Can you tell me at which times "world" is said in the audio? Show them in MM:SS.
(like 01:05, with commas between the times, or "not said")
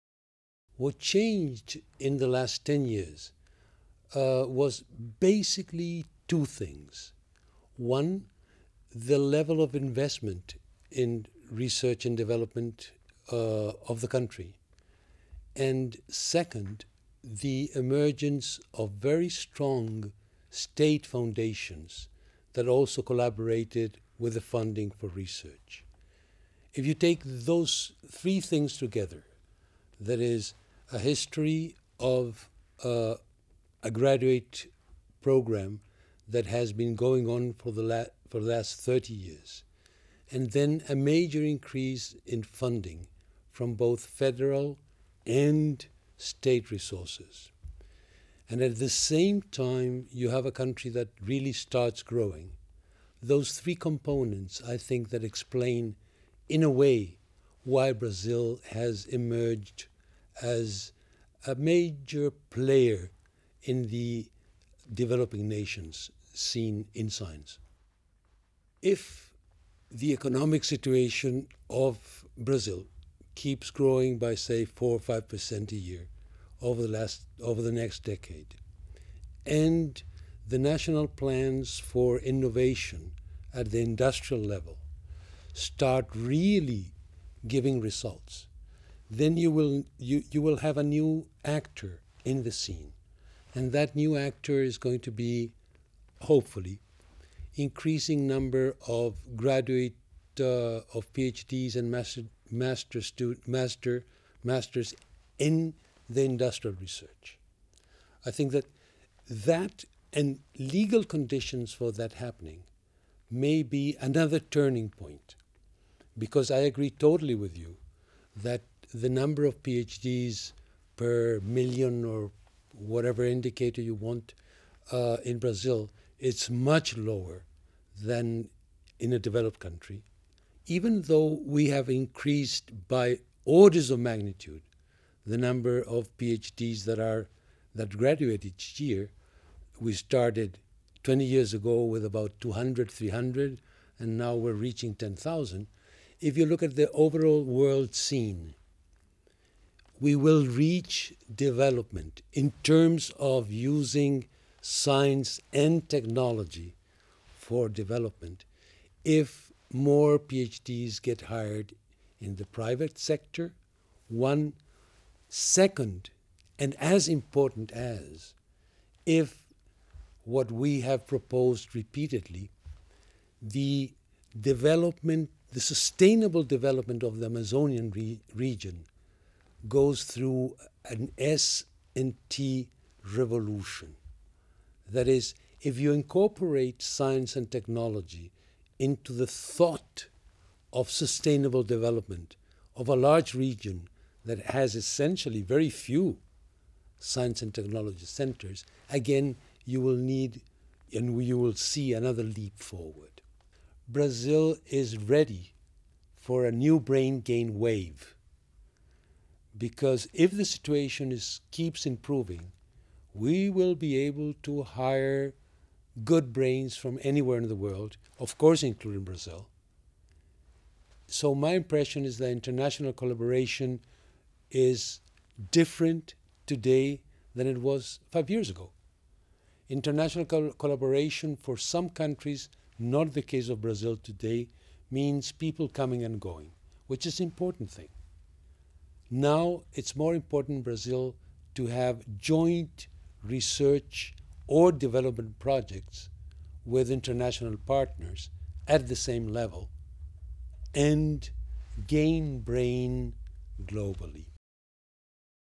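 02:27, 03:37.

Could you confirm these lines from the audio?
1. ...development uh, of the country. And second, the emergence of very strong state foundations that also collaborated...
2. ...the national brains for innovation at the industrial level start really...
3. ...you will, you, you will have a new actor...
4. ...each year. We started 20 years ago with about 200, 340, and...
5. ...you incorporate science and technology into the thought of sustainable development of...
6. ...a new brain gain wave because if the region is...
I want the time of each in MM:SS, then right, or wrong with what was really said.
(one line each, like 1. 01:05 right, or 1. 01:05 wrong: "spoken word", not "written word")
1. 00:12 right
2. 01:20 wrong: "plans", not "brains"
3. 01:29 right
4. 02:18 wrong: "300", not "340"
5. 03:05 right
6. 03:26 wrong: "situation", not "region".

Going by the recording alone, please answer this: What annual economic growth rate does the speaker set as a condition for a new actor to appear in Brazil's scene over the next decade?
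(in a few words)
4 or 5 percent.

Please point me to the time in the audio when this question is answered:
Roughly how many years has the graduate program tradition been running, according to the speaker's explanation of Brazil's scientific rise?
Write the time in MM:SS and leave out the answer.
00:38.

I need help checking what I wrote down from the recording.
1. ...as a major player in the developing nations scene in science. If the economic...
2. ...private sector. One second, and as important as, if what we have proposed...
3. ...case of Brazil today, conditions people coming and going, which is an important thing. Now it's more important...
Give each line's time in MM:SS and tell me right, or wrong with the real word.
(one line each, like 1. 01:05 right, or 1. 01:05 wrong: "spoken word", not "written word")
1. 01:00 right
2. 02:42 right
3. 03:53 wrong: "means", not "conditions".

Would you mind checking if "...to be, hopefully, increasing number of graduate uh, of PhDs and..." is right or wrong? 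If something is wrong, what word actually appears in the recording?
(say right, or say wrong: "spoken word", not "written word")
right.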